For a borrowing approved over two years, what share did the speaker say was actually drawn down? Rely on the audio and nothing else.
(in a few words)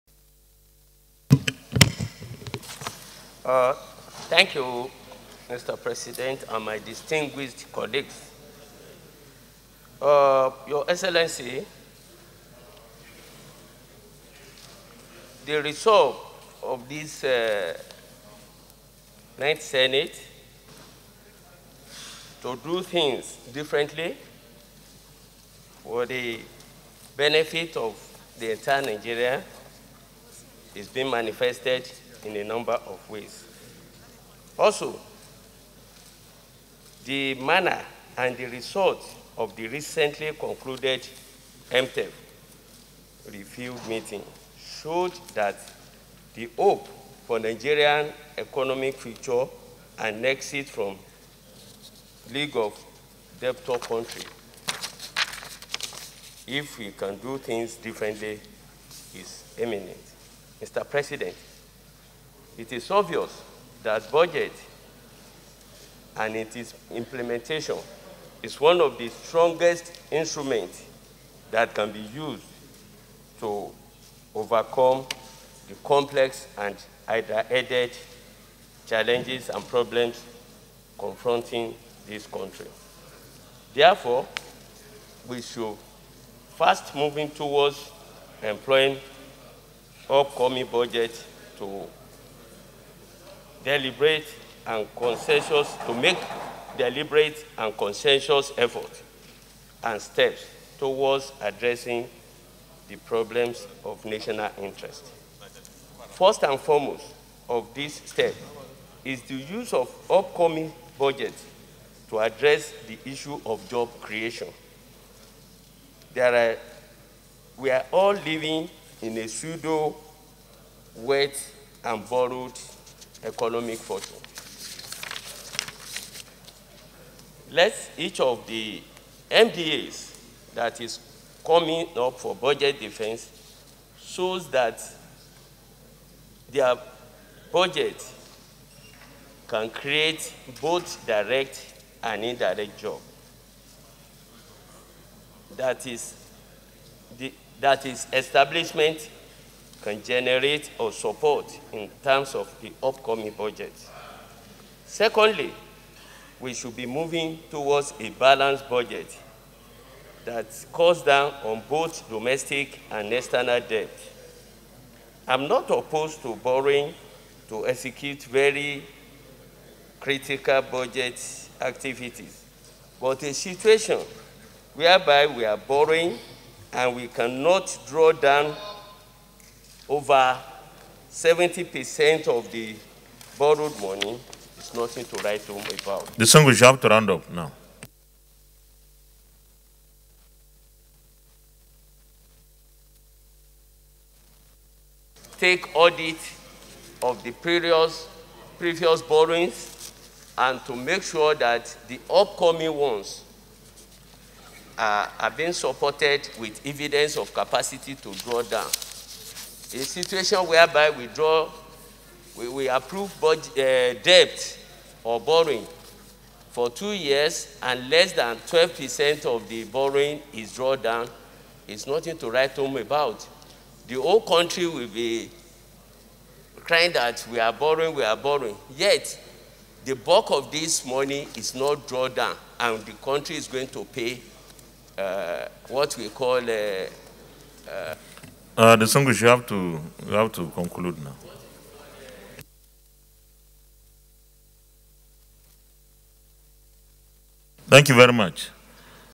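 less than 12%.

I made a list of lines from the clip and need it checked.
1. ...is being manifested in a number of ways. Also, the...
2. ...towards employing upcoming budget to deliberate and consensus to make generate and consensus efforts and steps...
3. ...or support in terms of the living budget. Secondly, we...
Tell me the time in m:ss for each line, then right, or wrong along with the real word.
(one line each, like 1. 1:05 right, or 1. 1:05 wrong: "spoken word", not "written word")
1. 0:30 right
2. 1:27 wrong: "deliberate", not "generate"
3. 2:30 wrong: "upcoming", not "living".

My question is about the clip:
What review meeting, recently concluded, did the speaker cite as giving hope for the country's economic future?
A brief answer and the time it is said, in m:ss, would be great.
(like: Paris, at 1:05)
MTEF review meeting, at 0:41.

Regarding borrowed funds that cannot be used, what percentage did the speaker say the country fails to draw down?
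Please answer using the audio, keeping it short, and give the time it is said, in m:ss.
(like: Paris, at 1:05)
over 70%, at 3:00.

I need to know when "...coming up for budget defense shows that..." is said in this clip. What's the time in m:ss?
2:11.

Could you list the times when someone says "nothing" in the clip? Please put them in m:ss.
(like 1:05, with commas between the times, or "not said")
3:04, 3:41.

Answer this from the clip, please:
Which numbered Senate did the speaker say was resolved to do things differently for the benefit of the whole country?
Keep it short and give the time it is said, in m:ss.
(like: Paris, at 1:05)
Ninth Senate, at 0:19.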